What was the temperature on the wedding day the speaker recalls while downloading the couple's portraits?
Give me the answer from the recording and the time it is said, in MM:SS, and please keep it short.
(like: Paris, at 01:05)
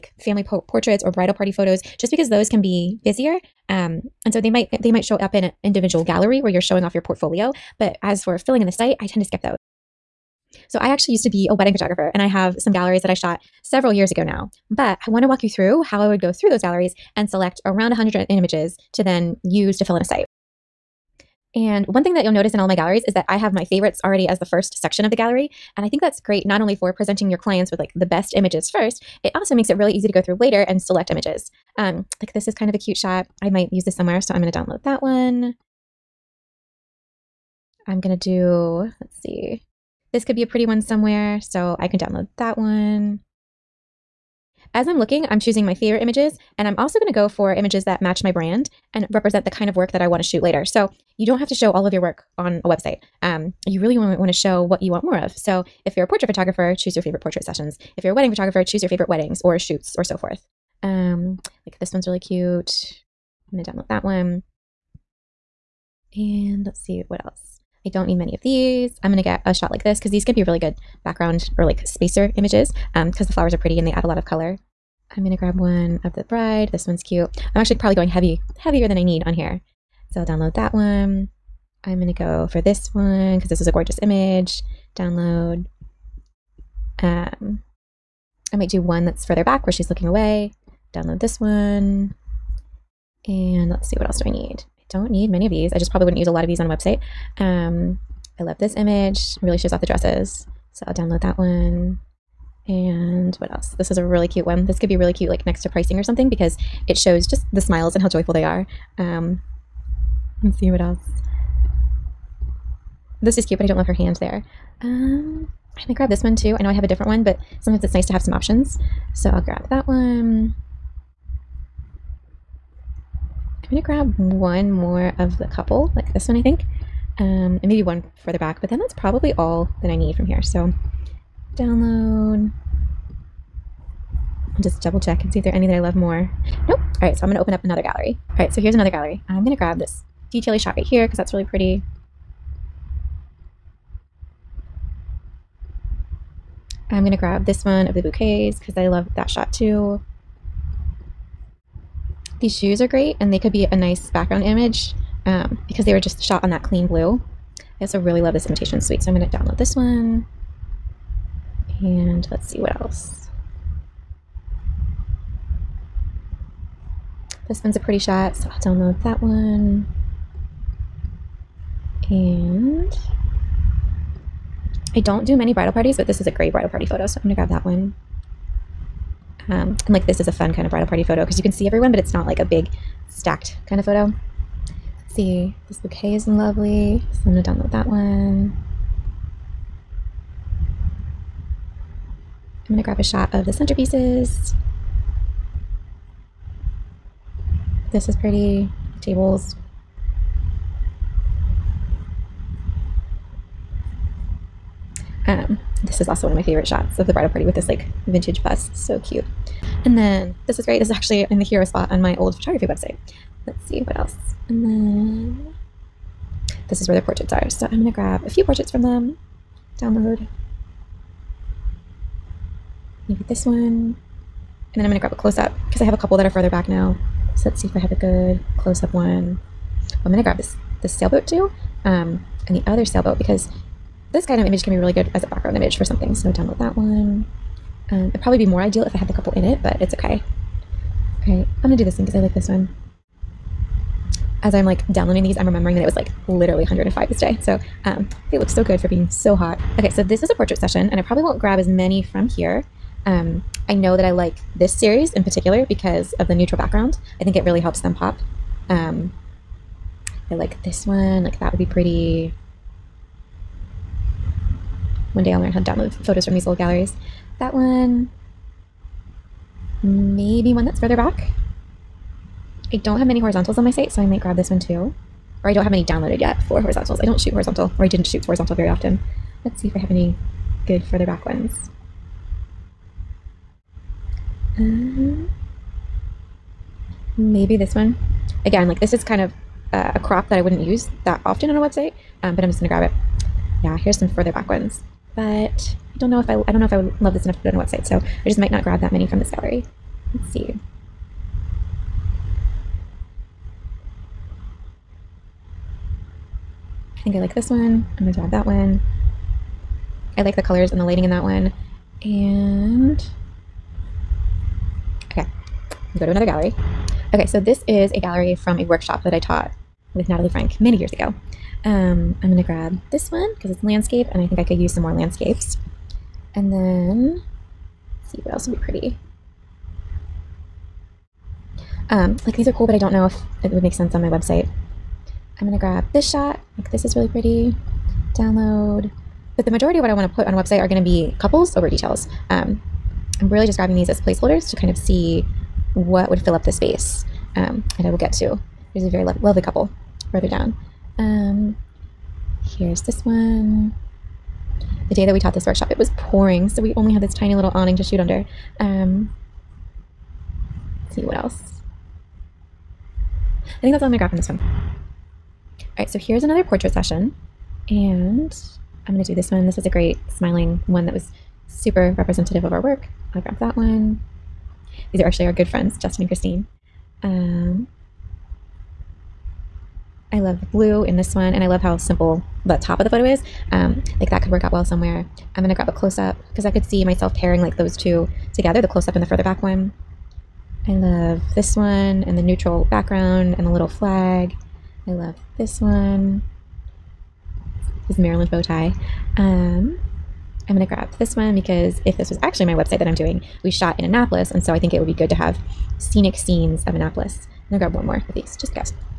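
105, at 04:06.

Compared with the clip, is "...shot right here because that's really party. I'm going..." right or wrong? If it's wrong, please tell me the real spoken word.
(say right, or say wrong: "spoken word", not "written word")
wrong: "pretty", not "party".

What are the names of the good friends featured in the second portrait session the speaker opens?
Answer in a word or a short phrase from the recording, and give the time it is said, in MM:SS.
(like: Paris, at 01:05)
Justin and Christine, at 06:15.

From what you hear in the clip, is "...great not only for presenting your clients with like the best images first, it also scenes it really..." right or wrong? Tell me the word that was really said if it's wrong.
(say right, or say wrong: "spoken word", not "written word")
wrong: "makes", not "scenes".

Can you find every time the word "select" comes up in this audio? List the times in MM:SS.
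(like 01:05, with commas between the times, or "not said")
00:17, 00:30.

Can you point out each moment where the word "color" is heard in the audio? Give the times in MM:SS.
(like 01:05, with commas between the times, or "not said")
01:14, 05:10.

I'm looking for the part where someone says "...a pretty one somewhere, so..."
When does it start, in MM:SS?
00:40.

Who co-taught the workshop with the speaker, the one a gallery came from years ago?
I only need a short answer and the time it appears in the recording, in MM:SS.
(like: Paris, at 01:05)
Natalie Frank, at 05:20.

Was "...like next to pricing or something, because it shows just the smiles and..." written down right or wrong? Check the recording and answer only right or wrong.
right.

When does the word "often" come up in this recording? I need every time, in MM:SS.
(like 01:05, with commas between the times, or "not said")
04:38, 04:51.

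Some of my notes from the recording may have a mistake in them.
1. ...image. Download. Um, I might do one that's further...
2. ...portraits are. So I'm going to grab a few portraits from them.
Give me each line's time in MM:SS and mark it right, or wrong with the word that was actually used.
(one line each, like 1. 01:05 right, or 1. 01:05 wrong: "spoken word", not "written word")
1. 01:24 right
2. 03:36 right.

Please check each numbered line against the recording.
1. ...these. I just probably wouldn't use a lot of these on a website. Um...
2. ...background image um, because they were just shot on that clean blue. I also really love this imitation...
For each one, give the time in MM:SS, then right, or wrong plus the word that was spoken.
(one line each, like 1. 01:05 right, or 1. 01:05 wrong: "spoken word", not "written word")
1. 01:35 right
2. 02:34 right.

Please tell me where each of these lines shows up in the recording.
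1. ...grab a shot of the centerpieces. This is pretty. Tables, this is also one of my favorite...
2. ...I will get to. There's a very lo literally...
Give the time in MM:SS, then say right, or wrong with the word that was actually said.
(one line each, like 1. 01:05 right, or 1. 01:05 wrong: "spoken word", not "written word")
1. 03:12 right
2. 05:47 wrong: "lovely", not "literally".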